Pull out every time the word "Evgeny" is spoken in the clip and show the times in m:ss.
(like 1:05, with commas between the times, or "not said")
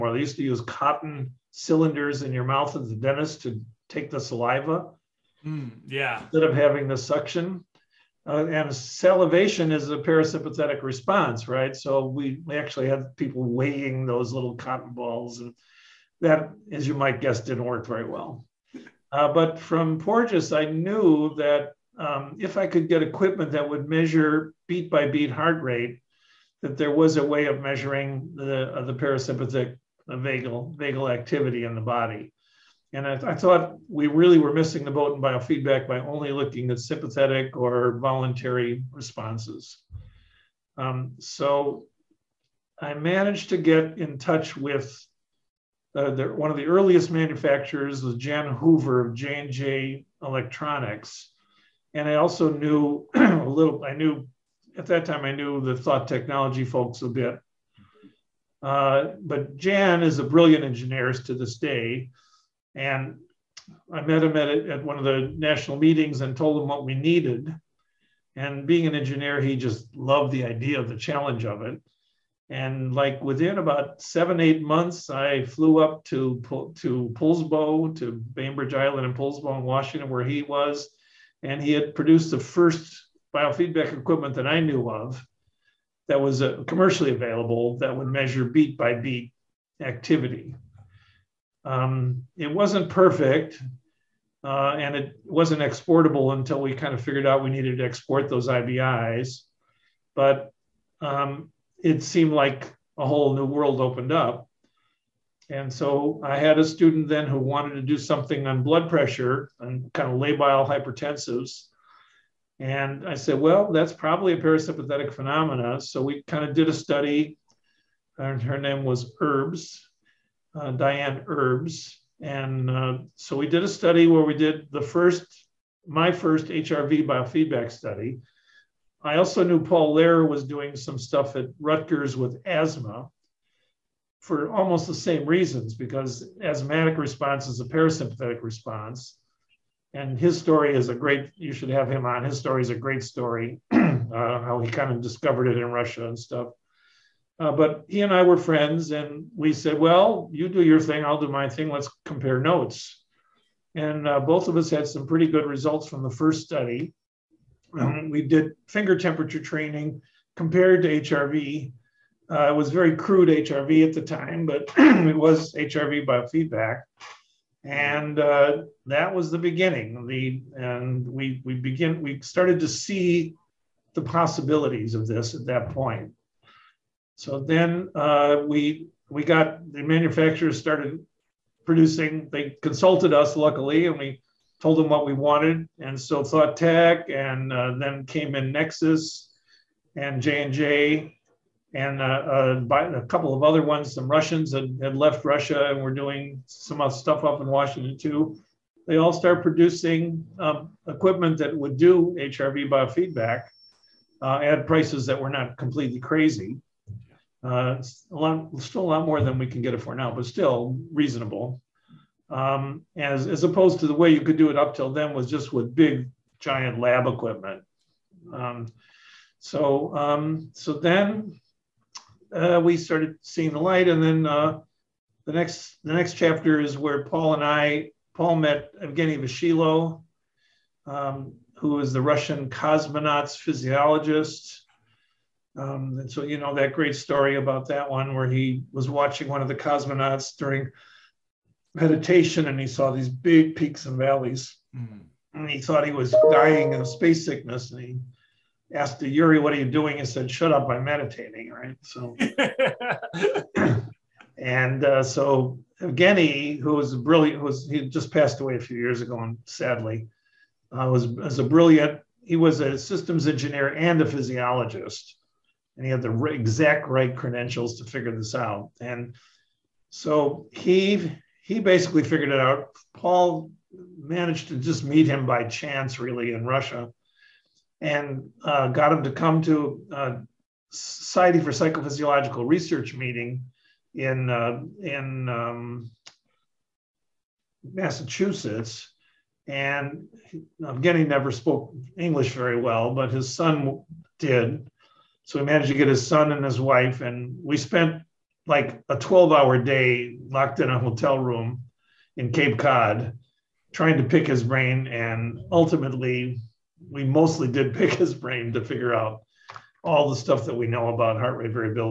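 3:48, 4:15.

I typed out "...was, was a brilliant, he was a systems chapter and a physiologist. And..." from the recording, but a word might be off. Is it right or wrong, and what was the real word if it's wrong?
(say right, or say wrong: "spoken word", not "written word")
wrong: "engineer", not "chapter".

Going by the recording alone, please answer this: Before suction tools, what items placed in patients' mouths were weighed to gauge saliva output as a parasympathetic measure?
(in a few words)
Cotton cylinders.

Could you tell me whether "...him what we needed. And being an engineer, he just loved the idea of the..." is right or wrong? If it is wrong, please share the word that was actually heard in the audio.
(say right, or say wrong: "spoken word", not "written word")
right.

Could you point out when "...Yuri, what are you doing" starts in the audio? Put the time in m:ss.
4:09.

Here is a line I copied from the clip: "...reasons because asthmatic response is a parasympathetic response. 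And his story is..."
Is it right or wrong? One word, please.
right.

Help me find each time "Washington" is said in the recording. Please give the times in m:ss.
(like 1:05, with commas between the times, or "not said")
1:19, 3:17.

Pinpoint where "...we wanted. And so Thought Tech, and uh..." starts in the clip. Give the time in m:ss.
3:05.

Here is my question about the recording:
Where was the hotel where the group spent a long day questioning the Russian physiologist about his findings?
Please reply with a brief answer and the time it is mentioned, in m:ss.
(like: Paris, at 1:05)
Cape Cod, at 5:02.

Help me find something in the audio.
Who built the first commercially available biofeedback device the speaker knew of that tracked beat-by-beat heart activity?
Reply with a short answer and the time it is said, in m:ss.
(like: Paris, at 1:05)
Jan Hoover, at 0:48.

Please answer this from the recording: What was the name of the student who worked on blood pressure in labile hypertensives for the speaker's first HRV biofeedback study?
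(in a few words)
Diane Herbs.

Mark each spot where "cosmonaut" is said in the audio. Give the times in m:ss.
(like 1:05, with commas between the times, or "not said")
3:52, 3:59.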